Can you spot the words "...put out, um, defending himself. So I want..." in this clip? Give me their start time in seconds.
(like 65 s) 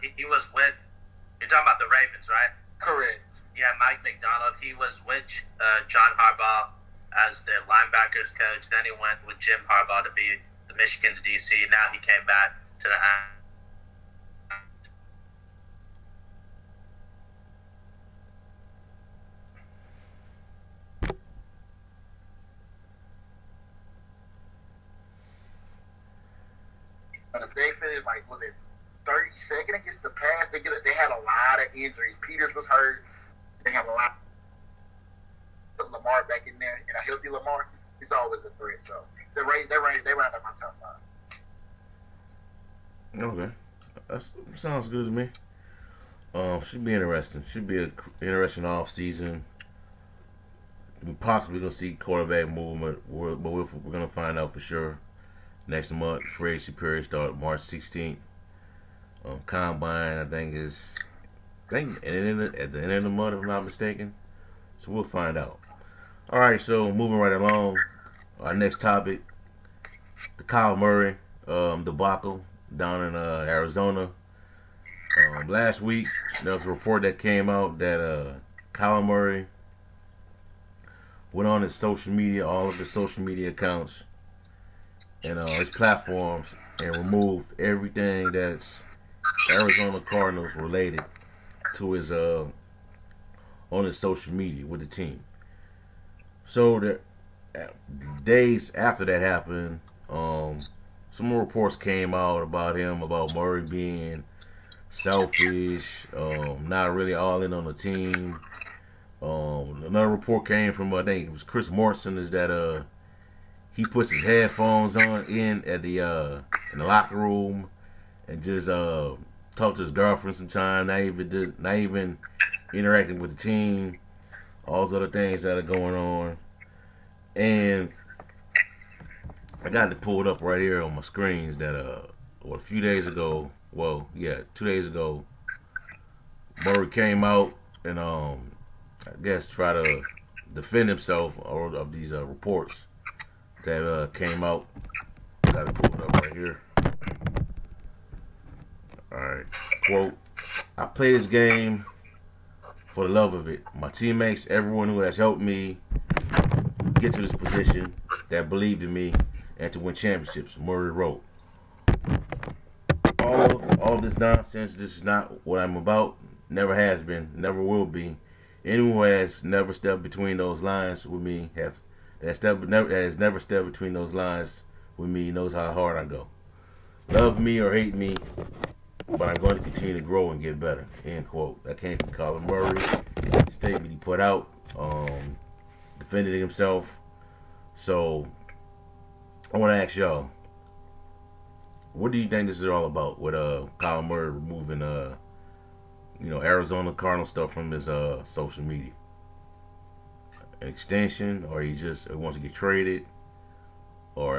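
183 s.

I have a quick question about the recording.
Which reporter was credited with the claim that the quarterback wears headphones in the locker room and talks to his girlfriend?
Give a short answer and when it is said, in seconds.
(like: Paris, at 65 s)
Chris Mortensen, at 111 s.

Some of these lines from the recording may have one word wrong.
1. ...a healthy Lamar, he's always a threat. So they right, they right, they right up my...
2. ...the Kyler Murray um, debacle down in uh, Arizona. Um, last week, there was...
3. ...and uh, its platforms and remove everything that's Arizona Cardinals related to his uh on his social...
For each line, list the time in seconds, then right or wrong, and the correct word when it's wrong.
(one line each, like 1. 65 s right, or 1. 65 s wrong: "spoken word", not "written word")
1. 37 s right
2. 70 s right
3. 85 s right.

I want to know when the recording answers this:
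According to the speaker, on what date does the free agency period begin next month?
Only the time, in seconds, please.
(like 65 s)
57 s.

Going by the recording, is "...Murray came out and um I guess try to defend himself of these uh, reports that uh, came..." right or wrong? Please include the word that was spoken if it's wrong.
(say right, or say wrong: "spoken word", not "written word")
right.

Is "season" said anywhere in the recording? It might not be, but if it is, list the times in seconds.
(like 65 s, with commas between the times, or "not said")
48 s.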